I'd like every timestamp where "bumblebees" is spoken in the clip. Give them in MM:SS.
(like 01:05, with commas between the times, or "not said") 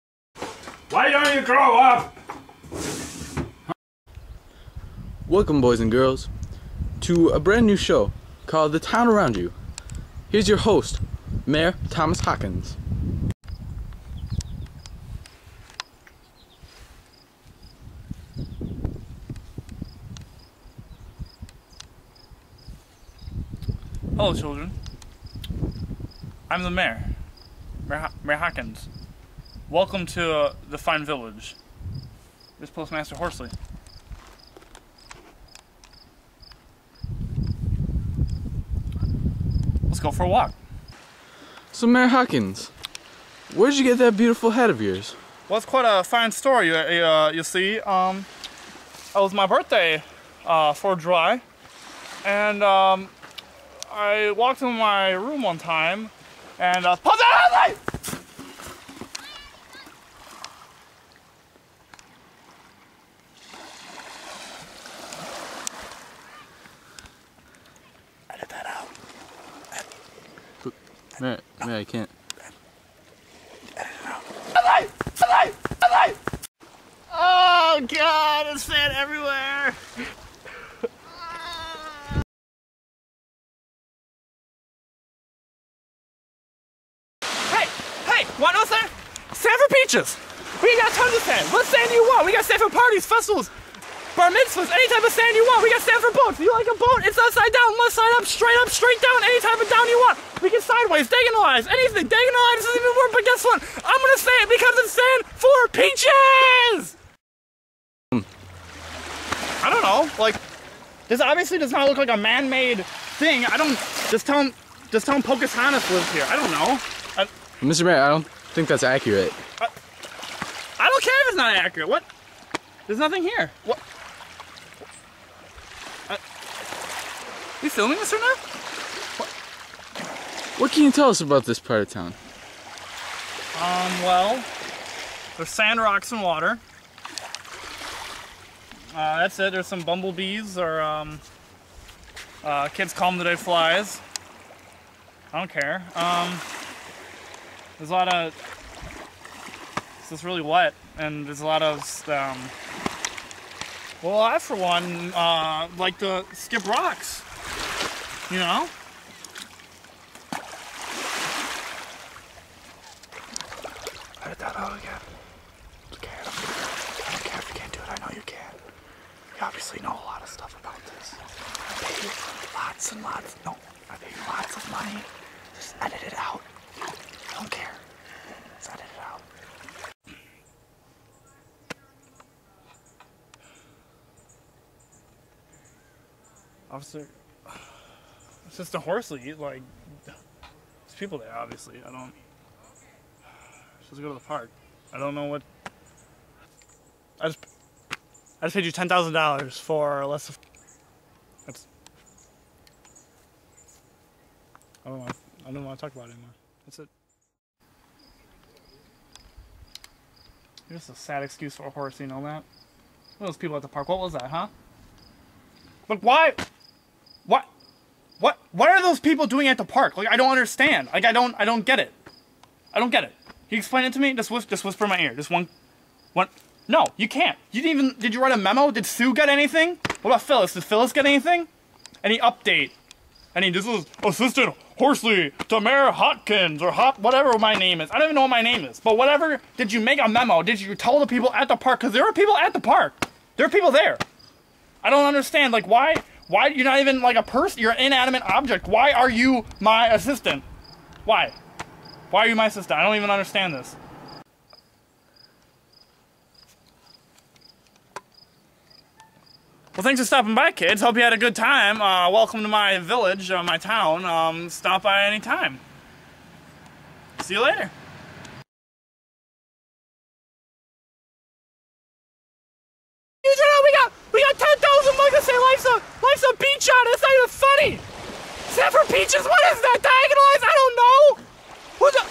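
02:19.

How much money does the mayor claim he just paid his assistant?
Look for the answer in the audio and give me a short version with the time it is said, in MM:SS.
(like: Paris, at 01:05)
$10,000, at 03:18.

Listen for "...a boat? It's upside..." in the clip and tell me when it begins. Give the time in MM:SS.
01:36.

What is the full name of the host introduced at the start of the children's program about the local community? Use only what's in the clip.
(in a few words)
Thomas Hawkins.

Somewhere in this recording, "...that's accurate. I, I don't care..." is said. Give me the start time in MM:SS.
01:58.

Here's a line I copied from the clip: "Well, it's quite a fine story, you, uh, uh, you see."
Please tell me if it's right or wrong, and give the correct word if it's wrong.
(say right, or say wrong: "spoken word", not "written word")
right.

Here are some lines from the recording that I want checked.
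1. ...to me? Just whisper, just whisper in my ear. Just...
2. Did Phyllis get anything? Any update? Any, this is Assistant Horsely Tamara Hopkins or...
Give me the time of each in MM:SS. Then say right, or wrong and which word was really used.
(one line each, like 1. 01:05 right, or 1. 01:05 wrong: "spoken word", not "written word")
1. 03:43 right
2. 03:50 right.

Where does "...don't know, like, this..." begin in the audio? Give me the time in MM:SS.
01:49.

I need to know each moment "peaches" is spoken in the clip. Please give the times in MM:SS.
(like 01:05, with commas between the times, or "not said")
01:29, 01:45, 04:38.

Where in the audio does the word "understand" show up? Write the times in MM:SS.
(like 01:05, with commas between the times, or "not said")
03:40, 04:05, 04:13.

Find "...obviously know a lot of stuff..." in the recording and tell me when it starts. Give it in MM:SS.
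02:49.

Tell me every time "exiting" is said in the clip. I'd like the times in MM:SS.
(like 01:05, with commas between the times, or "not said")
not said.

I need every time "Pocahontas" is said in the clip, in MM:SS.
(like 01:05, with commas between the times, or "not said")
01:55.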